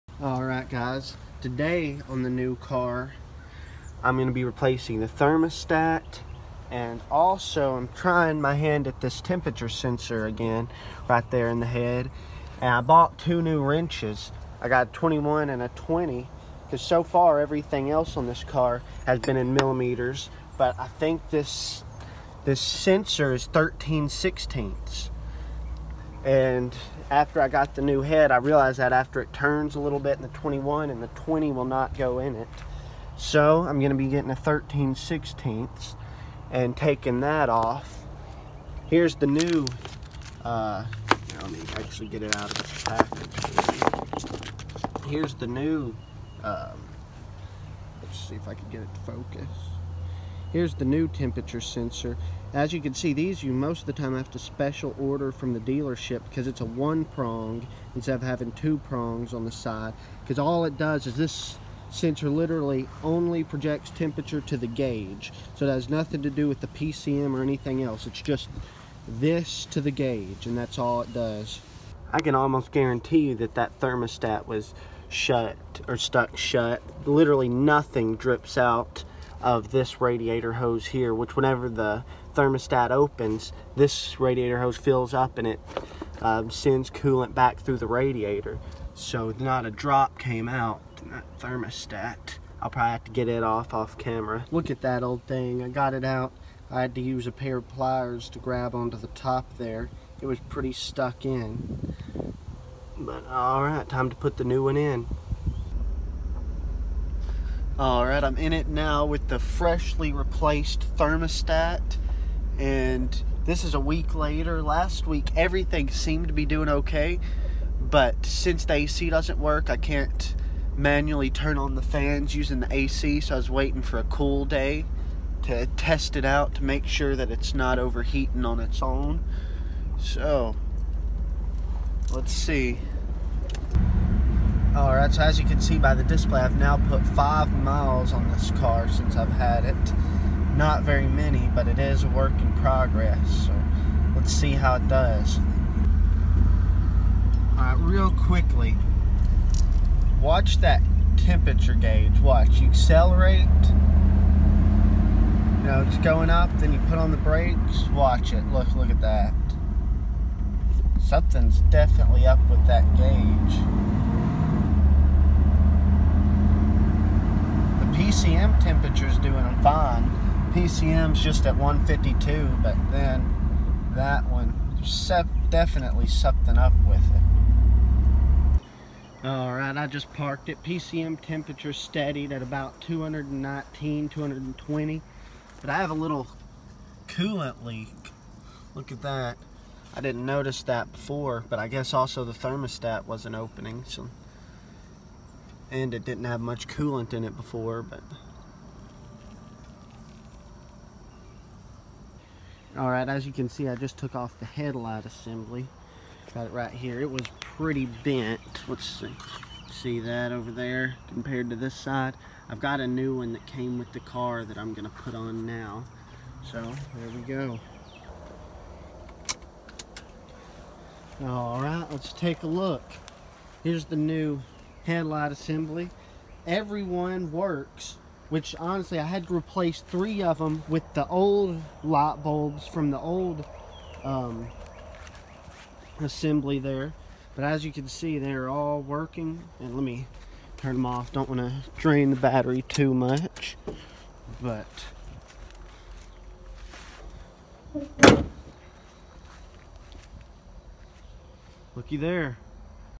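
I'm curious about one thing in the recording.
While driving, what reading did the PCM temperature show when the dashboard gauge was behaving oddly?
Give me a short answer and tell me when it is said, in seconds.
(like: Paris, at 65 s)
152, at 171 s.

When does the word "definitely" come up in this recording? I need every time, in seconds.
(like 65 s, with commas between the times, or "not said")
161 s, 175 s.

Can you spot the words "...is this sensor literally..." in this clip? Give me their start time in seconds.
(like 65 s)
61 s.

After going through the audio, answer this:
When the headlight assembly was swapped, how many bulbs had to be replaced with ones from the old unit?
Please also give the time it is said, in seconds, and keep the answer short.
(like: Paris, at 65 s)
3, at 229 s.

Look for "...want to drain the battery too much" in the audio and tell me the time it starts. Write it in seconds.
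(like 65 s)
241 s.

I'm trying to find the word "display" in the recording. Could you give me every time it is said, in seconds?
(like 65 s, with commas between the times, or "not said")
136 s.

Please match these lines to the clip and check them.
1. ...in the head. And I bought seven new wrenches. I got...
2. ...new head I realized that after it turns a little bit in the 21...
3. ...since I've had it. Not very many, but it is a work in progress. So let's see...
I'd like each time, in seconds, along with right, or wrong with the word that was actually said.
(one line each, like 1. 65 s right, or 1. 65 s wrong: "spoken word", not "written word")
1. 11 s wrong: "two", not "seven"
2. 27 s right
3. 138 s right.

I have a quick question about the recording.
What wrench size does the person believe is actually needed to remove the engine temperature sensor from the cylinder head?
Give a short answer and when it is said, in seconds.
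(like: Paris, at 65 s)
13/16, at 23 s.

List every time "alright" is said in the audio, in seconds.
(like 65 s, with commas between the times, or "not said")
0 s, 103 s, 179 s, 202 s.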